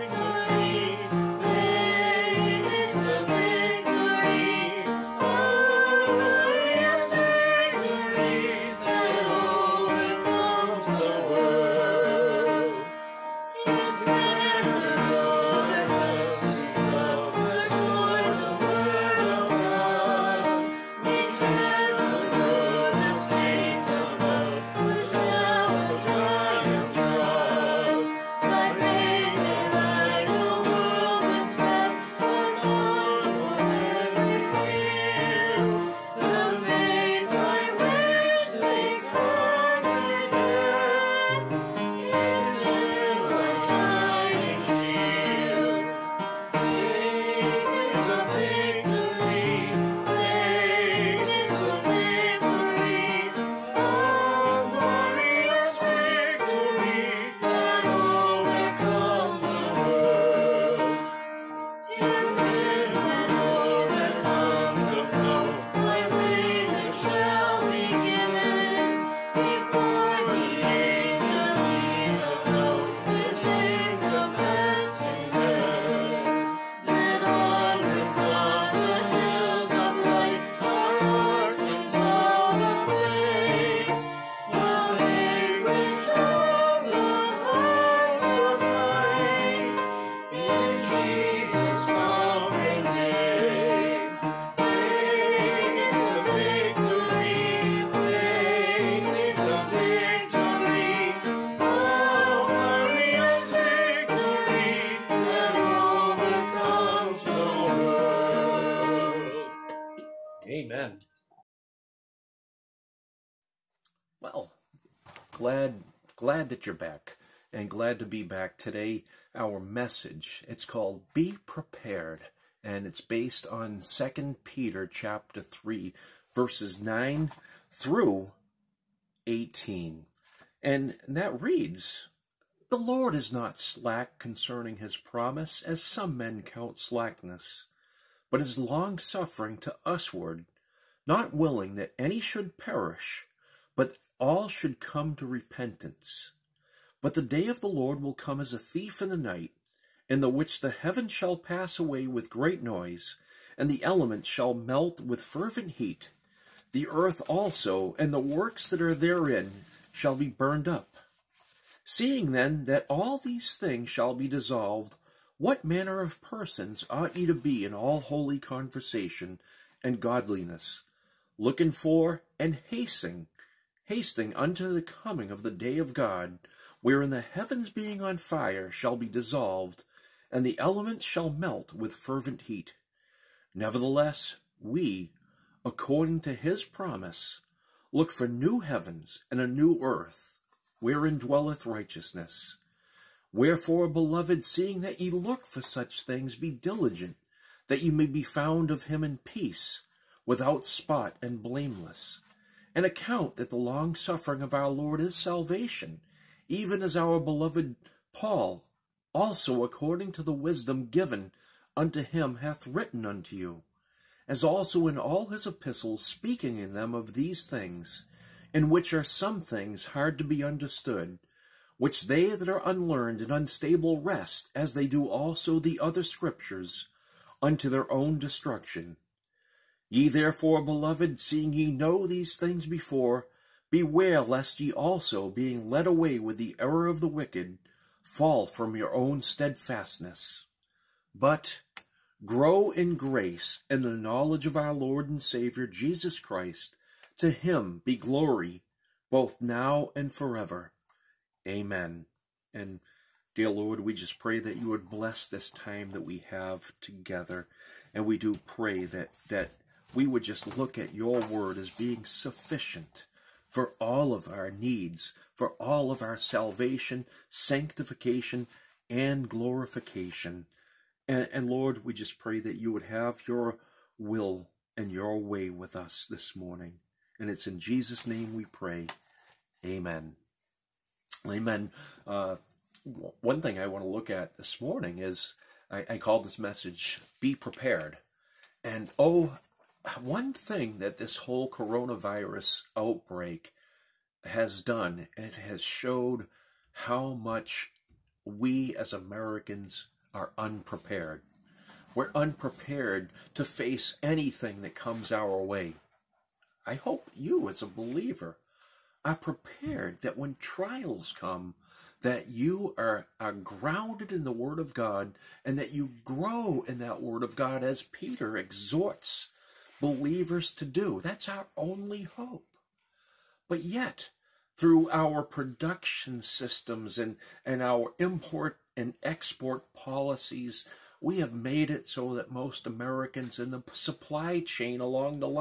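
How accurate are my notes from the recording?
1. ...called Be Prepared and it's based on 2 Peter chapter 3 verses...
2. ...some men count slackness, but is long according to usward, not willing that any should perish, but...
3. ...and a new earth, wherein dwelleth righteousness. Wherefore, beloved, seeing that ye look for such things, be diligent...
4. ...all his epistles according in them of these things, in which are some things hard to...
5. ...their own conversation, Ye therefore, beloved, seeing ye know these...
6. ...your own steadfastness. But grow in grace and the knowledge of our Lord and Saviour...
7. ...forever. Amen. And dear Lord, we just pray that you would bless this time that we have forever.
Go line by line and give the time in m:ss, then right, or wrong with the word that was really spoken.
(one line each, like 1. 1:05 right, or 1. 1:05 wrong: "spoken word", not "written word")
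1. 2:00 right
2. 2:15 wrong: "suffering", not "according"
3. 3:09 right
4. 3:34 wrong: "speaking", not "according"
5. 3:47 wrong: "destruction", not "conversation"
6. 3:58 right
7. 4:10 wrong: "together", not "forever".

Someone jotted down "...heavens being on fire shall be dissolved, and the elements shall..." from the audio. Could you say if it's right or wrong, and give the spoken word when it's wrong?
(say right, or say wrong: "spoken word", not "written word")
right.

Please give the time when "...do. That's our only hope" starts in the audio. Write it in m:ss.
5:20.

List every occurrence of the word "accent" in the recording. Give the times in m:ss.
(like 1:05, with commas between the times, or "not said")
not said.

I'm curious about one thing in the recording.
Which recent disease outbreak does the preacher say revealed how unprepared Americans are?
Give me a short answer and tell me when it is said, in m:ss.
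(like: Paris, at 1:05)
Coronavirus, at 4:51.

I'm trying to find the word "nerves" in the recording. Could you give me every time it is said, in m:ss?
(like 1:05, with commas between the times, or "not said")
not said.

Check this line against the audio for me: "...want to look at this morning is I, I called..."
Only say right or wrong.
right.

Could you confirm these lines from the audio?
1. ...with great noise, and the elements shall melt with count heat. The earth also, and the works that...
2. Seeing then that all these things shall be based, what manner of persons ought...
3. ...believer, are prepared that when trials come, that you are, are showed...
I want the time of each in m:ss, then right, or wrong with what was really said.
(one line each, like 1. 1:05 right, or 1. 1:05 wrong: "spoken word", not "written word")
1. 2:32 wrong: "fervent", not "count"
2. 2:41 wrong: "dissolved", not "based"
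3. 5:07 wrong: "grounded", not "showed".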